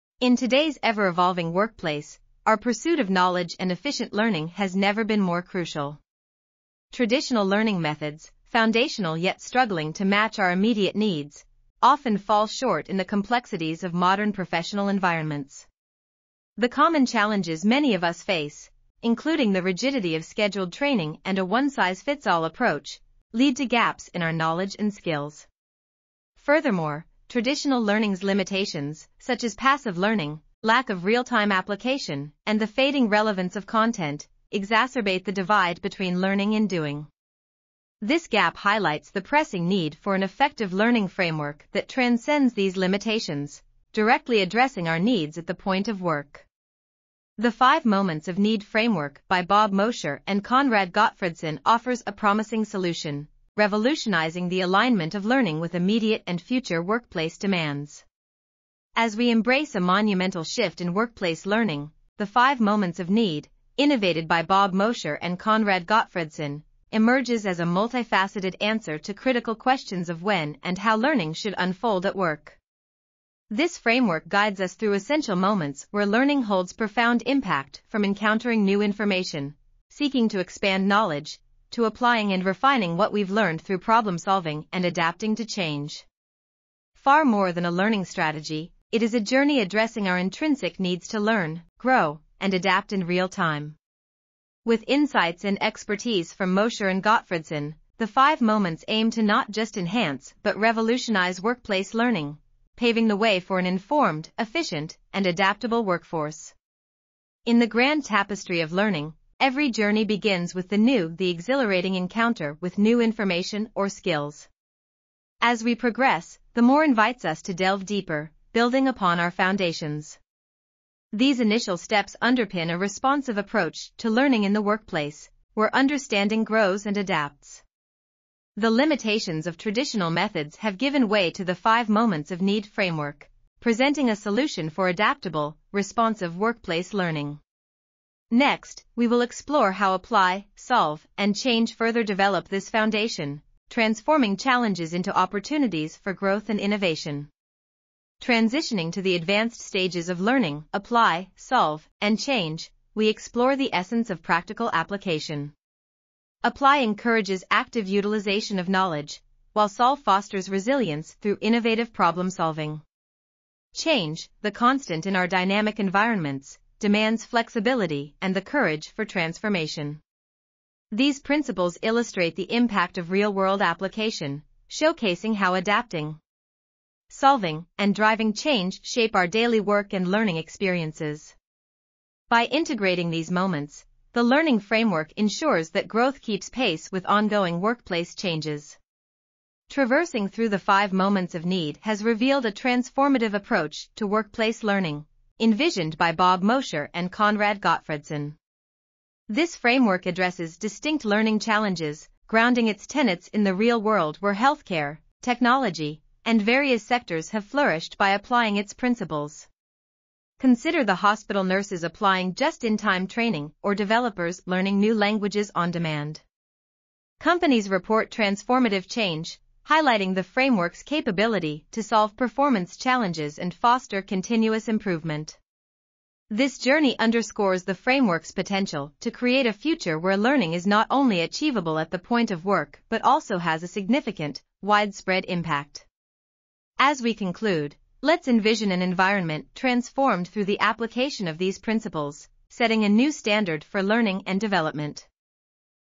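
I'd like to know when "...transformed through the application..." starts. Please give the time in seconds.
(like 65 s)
239 s.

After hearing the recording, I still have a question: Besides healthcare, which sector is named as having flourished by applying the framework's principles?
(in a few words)
technology.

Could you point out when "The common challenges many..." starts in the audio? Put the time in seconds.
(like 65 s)
16 s.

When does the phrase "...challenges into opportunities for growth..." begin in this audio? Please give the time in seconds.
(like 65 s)
144 s.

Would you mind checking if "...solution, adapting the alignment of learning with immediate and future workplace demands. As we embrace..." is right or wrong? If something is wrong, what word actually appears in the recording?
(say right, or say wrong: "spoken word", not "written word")
wrong: "revolutionizing", not "adapting".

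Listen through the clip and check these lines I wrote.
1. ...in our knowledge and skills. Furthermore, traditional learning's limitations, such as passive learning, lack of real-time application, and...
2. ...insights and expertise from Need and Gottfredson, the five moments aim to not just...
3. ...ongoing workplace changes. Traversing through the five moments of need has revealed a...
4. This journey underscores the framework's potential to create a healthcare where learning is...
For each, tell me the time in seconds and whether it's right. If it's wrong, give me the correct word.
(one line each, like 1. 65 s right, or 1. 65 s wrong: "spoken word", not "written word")
1. 24 s right
2. 94 s wrong: "Mosher", not "Need"
3. 187 s right
4. 226 s wrong: "future", not "healthcare".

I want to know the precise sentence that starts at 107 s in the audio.
In the grand tapestry of learning, every journey begins with the new, the exhilarating encounter with new information or skills.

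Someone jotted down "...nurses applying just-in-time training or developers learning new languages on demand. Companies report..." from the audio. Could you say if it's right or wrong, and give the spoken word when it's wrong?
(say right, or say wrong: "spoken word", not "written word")
right.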